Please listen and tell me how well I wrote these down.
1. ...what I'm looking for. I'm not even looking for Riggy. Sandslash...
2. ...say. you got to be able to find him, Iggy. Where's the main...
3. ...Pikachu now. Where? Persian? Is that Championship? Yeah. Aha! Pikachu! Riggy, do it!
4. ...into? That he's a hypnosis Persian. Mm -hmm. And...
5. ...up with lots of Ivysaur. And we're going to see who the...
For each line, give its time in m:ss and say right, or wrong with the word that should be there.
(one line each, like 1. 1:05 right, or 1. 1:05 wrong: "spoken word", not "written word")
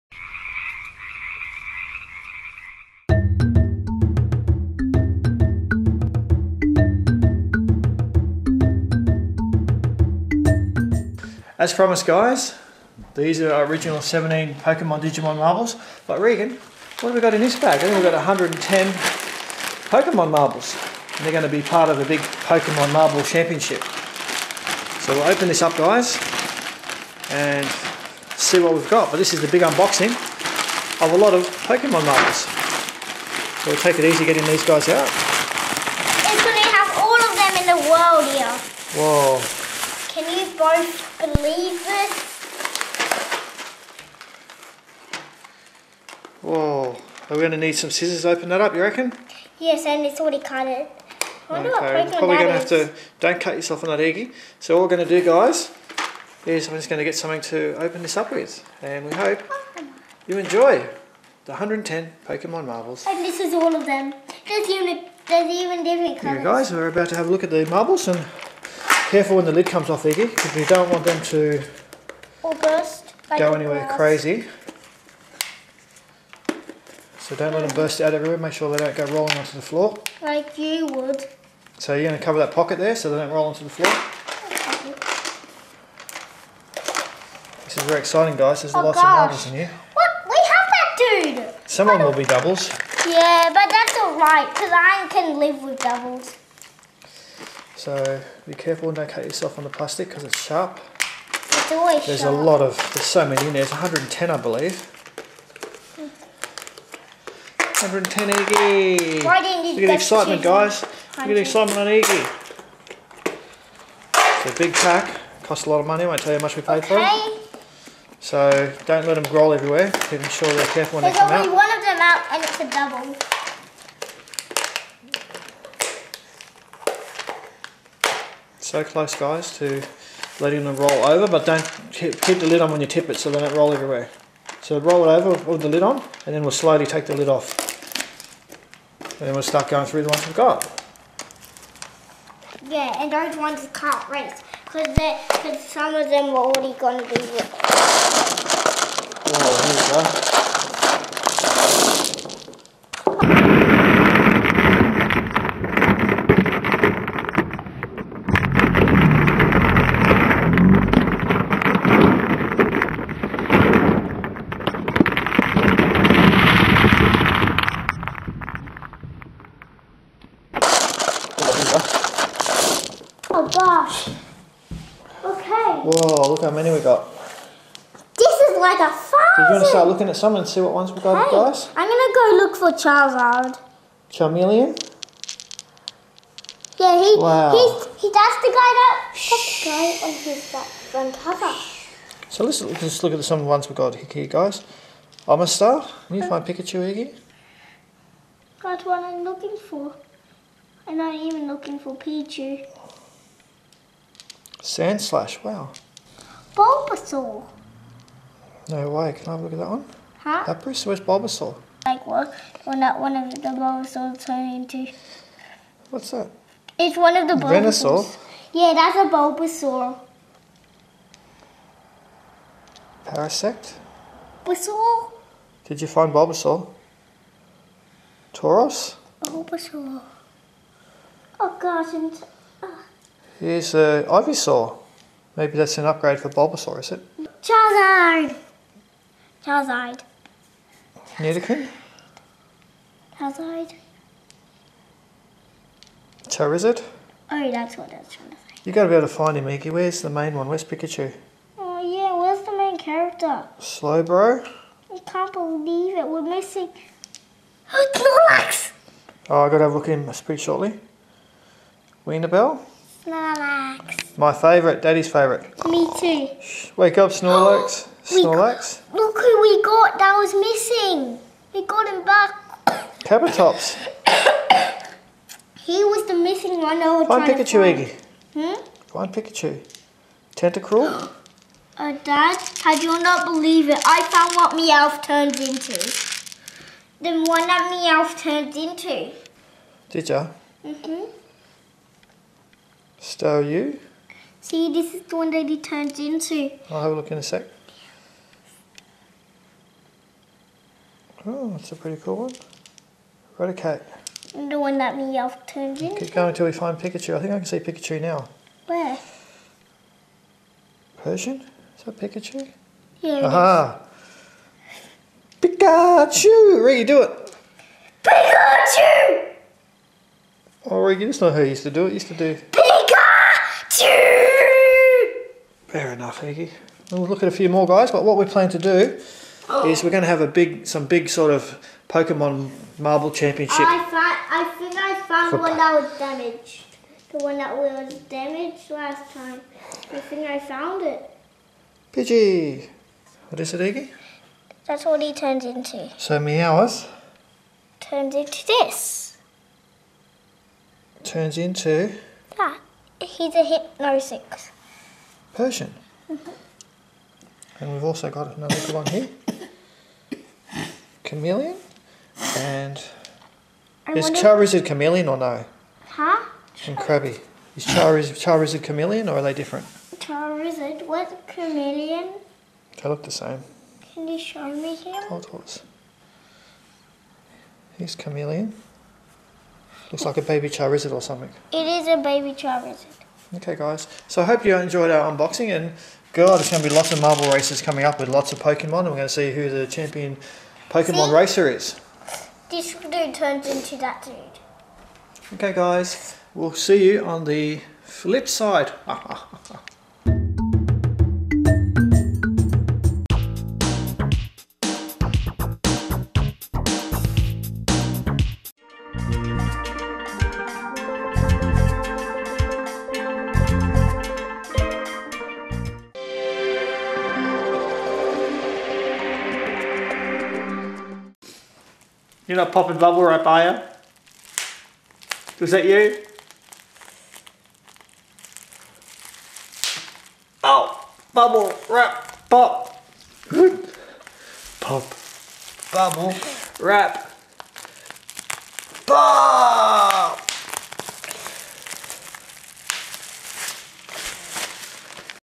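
1. 3:18 wrong: "Pichu", not "Riggy"
2. 4:08 right
3. 5:07 wrong: "Pikachu", not "Championship"
4. 5:51 right
5. 6:27 wrong: "Pokemon", not "Ivysaur".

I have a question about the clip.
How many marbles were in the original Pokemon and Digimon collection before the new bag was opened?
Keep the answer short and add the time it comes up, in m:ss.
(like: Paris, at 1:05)
17, at 0:14.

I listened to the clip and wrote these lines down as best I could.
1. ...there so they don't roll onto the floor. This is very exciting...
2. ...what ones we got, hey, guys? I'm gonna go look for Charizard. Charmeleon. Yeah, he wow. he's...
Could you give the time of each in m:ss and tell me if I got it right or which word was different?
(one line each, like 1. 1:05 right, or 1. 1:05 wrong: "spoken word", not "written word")
1. 1:22 right
2. 3:00 right.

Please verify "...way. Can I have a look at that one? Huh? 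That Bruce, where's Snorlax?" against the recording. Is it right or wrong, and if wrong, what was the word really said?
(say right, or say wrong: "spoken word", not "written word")
wrong: "Bulbasaur", not "Snorlax".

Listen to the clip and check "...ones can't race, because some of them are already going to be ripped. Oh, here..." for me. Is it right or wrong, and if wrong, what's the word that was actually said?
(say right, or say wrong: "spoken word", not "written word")
right.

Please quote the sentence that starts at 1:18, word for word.
Make sure they don't go rolling onto the floor.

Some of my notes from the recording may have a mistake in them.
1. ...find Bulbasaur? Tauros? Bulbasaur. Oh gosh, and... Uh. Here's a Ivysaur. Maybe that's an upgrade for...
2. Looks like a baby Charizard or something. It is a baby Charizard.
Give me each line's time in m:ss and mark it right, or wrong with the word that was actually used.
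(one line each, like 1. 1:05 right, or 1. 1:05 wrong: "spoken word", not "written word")
1. 3:45 right
2. 6:19 right.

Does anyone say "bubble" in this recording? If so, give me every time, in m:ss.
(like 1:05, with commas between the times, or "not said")
7:02, 7:11, 7:15.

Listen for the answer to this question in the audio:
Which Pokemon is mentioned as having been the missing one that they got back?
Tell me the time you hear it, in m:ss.
4:33.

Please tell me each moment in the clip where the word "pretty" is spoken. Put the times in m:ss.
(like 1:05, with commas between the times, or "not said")
4:20, 5:01.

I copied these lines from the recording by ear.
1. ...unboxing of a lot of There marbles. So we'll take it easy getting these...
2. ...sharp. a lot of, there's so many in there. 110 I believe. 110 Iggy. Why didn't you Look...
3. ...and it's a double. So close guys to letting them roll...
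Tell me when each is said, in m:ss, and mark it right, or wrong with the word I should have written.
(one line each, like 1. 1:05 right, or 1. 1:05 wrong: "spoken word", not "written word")
1. 0:29 wrong: "Pokemon", not "There"
2. 1:42 right
3. 2:02 right.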